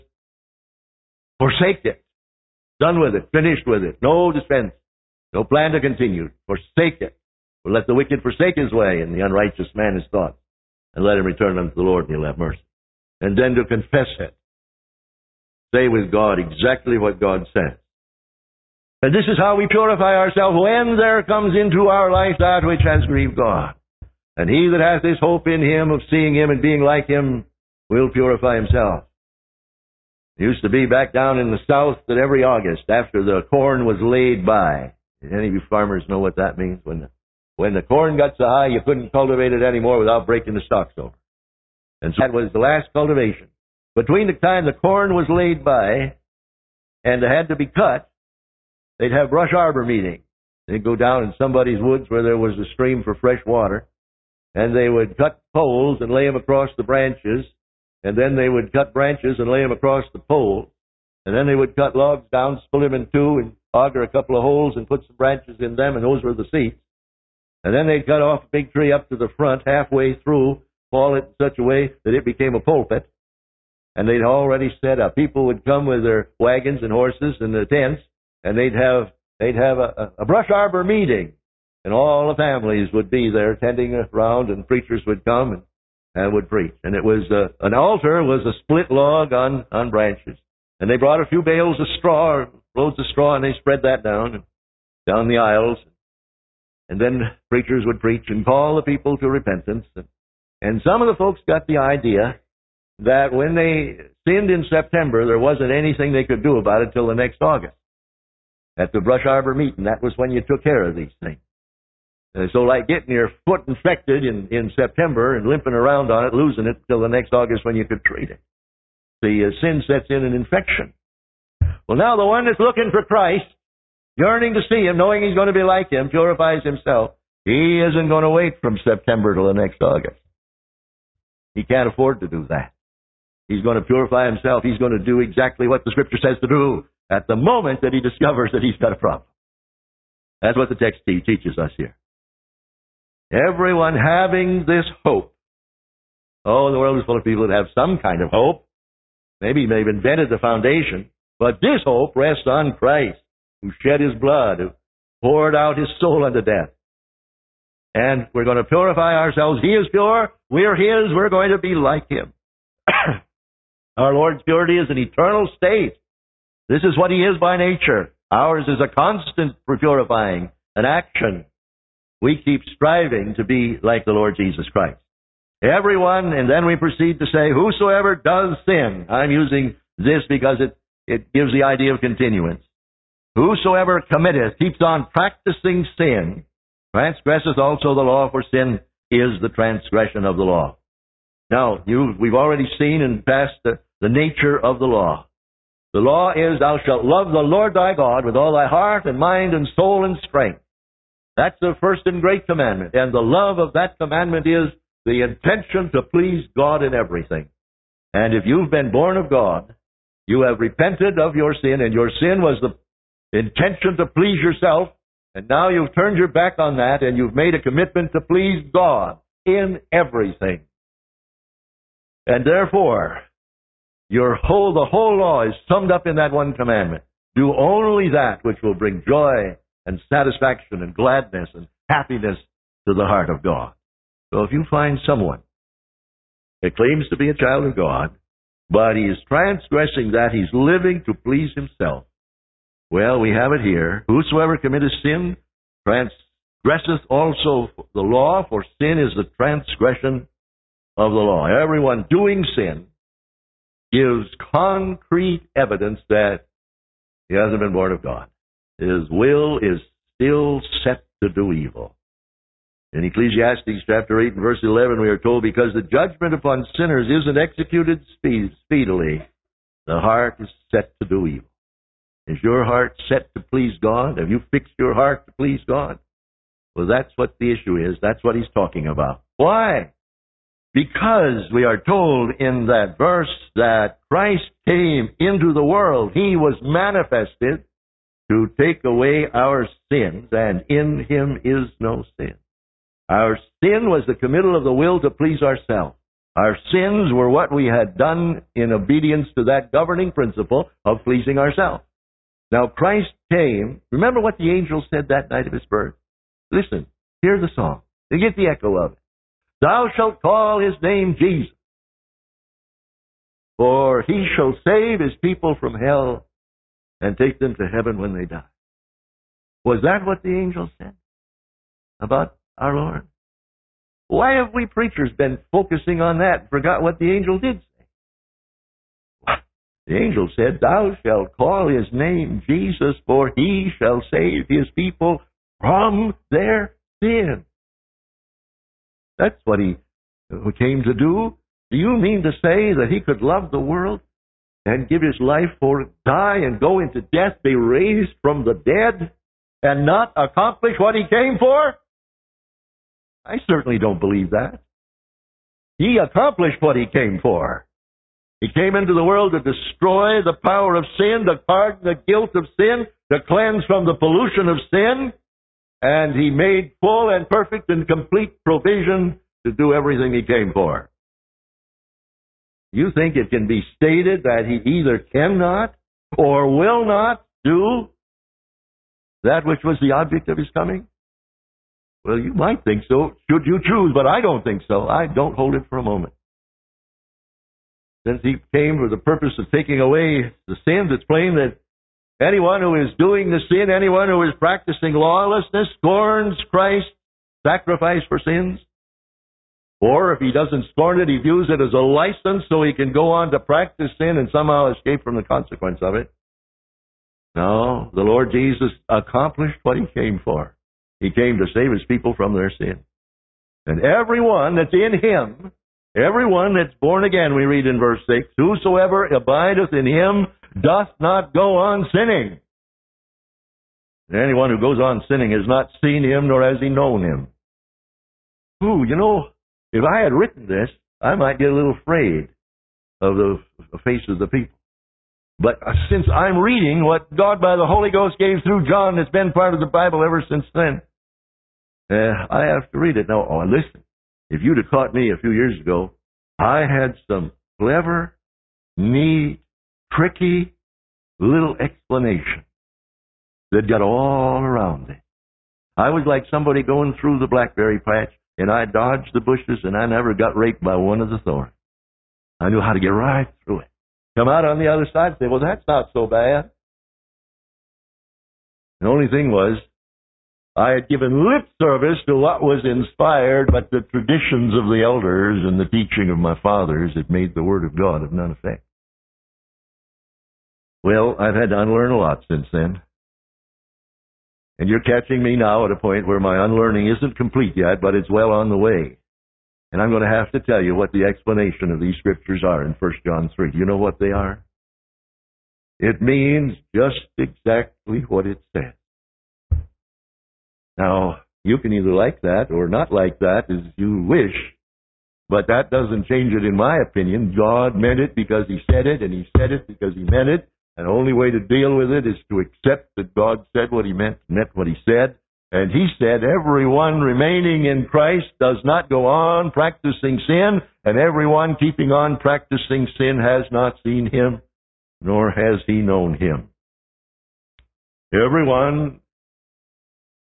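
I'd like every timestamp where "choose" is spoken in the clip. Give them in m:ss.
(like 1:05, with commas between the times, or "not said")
6:23.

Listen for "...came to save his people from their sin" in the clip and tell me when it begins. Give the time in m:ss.
6:51.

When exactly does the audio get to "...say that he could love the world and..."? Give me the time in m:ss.
5:42.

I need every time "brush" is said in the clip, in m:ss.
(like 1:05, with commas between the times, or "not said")
0:49, 1:20, 1:49.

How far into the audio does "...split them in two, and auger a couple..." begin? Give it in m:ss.
1:02.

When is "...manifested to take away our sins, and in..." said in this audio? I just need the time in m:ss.
4:46.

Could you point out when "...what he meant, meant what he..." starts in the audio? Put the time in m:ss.
8:33.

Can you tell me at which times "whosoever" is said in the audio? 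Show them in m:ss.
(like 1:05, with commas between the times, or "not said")
2:57, 3:03, 4:04, 6:58.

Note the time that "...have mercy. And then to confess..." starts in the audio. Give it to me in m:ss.
0:12.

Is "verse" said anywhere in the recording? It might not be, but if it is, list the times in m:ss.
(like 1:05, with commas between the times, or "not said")
4:24, 4:42, 6:57.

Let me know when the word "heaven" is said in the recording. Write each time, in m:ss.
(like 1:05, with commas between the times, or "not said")
5:17.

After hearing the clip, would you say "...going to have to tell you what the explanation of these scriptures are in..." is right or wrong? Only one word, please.
right.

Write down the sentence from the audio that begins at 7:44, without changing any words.
Come out on the other side and say, well, that's not so bad.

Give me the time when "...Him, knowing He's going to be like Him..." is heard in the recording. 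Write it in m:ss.
2:04.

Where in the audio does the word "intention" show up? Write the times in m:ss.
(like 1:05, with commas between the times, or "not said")
3:25, 3:33.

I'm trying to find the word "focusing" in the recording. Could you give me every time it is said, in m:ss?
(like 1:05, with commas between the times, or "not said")
5:25.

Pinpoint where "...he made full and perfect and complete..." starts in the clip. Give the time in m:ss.
6:06.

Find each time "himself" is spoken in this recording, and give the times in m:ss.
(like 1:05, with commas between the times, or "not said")
0:28, 2:06, 2:14, 4:01.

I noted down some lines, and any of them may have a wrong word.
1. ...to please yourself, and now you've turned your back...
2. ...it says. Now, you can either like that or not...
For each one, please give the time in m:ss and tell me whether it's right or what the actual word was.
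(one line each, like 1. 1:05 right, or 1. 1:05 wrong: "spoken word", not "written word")
1. 3:33 right
2. 8:18 right.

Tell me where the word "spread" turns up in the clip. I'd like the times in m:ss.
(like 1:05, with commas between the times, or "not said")
1:33.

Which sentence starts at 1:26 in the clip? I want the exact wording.
And it was uh, an altar was a split log on on branches.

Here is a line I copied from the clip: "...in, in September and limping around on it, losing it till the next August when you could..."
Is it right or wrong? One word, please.
right.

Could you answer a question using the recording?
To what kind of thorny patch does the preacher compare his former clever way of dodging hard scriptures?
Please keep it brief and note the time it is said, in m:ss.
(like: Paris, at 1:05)
Blackberry patch, at 7:37.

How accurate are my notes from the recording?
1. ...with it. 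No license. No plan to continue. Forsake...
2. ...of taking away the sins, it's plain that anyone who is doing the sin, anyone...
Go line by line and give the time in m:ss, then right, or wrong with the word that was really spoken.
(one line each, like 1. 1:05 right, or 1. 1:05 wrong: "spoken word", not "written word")
1. 0:03 wrong: "defense", not "license"
2. 6:29 right.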